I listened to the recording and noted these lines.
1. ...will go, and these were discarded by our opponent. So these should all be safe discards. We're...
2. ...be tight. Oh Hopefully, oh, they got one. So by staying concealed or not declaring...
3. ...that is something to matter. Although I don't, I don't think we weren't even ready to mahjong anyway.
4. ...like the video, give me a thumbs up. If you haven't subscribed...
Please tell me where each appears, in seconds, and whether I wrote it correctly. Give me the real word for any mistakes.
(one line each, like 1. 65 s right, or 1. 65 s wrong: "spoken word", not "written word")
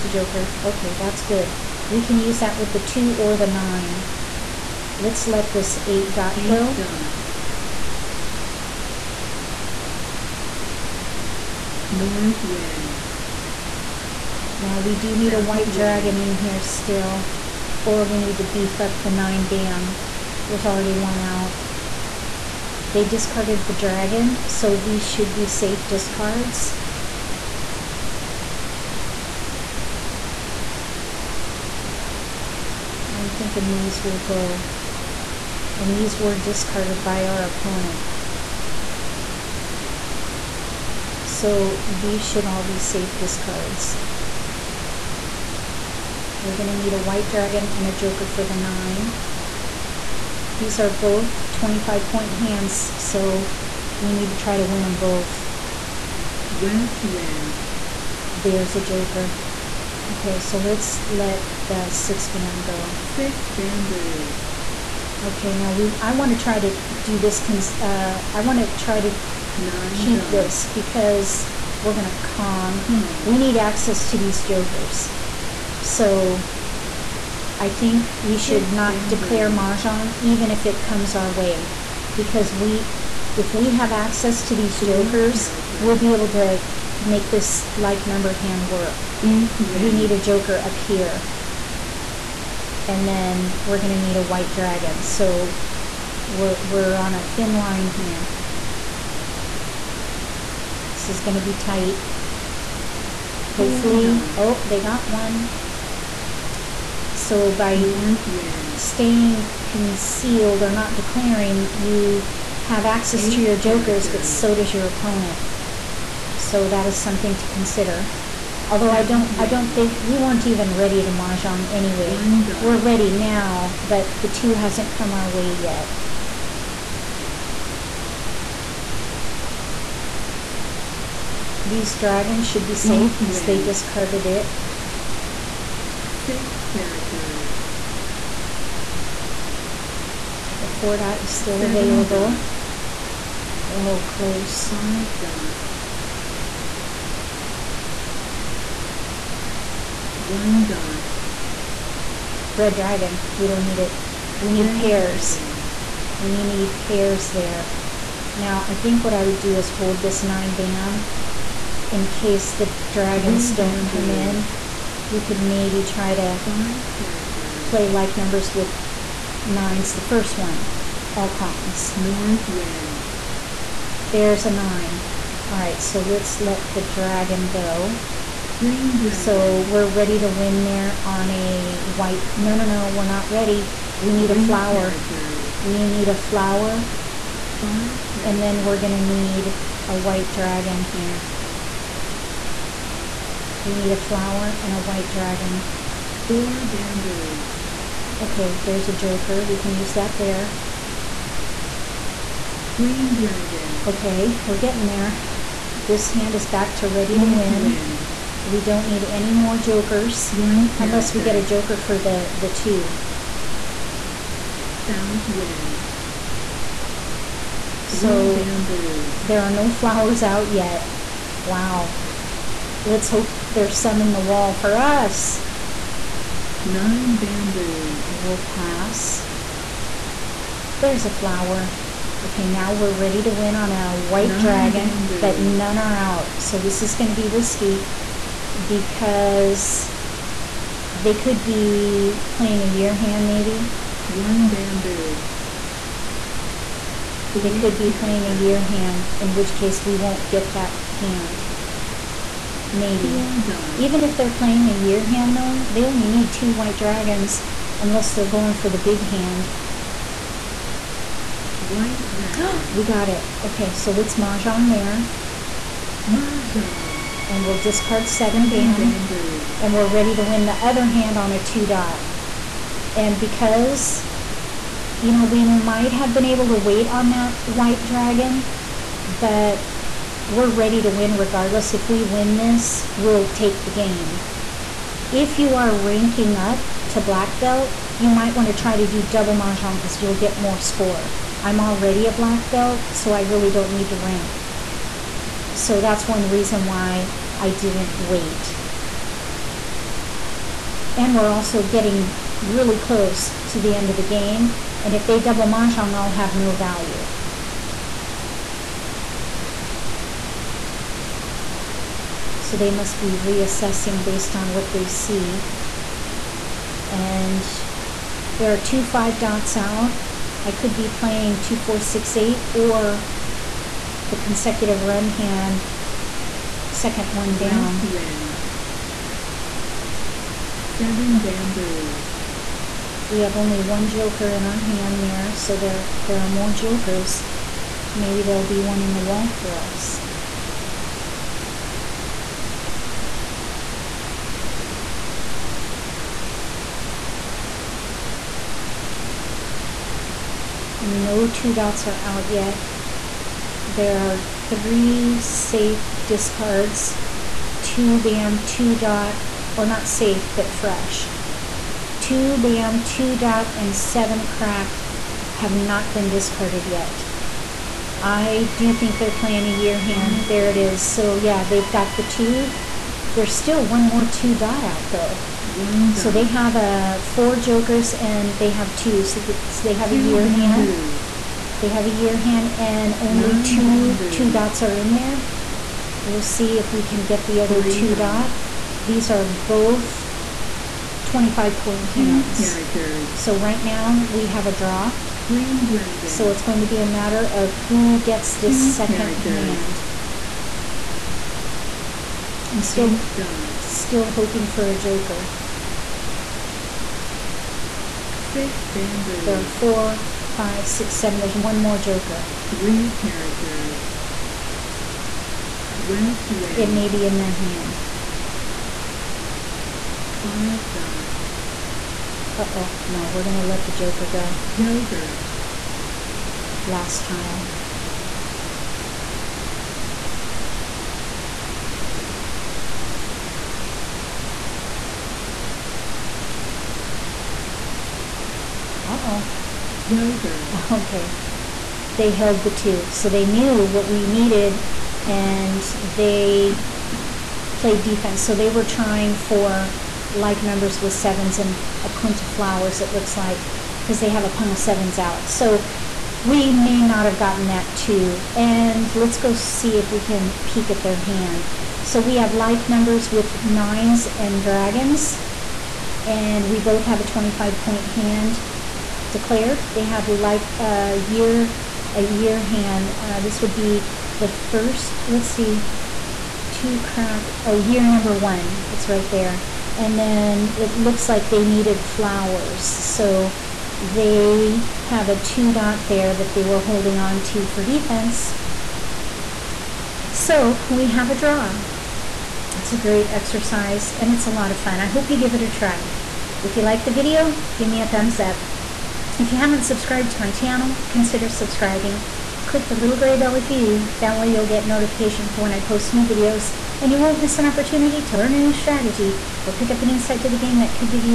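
1. 34 s right
2. 101 s right
3. 116 s wrong: "consider", not "matter"
4. 496 s right.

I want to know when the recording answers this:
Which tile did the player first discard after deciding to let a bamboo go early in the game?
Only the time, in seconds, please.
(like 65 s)
61 s.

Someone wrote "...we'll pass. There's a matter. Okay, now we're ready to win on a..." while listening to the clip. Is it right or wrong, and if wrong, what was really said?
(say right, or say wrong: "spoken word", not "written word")
wrong: "flower", not "matter".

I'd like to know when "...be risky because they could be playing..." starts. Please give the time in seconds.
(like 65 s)
237 s.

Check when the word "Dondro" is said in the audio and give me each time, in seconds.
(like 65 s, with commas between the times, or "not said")
not said.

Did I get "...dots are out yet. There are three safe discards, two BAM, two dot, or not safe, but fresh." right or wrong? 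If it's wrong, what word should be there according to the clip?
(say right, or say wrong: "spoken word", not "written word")
right.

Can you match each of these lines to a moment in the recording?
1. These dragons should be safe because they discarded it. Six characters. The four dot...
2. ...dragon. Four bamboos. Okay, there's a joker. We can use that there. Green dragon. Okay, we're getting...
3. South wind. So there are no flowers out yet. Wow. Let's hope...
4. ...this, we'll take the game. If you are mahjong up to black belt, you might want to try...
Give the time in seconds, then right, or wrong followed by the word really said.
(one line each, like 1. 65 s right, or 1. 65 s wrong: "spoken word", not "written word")
1. 131 s right
2. 195 s right
3. 214 s right
4. 282 s wrong: "ranking", not "mahjong".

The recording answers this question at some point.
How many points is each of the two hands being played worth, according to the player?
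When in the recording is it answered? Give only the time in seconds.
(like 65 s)
50 s.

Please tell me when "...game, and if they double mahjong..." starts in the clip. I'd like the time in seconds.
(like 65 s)
304 s.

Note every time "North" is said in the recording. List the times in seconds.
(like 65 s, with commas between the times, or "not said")
11 s, 171 s.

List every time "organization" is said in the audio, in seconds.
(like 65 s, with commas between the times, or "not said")
not said.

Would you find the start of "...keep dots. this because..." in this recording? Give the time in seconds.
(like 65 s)
69 s.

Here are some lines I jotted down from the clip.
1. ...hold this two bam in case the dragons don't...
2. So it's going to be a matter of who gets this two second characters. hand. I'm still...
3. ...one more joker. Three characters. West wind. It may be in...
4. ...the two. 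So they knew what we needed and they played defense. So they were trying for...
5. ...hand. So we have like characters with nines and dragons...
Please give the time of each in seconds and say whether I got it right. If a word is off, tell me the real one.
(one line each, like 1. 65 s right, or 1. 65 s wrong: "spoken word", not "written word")
1. 159 s wrong: "nine", not "two"
2. 396 s right
3. 411 s right
4. 442 s right
5. 460 s wrong: "numbers", not "characters".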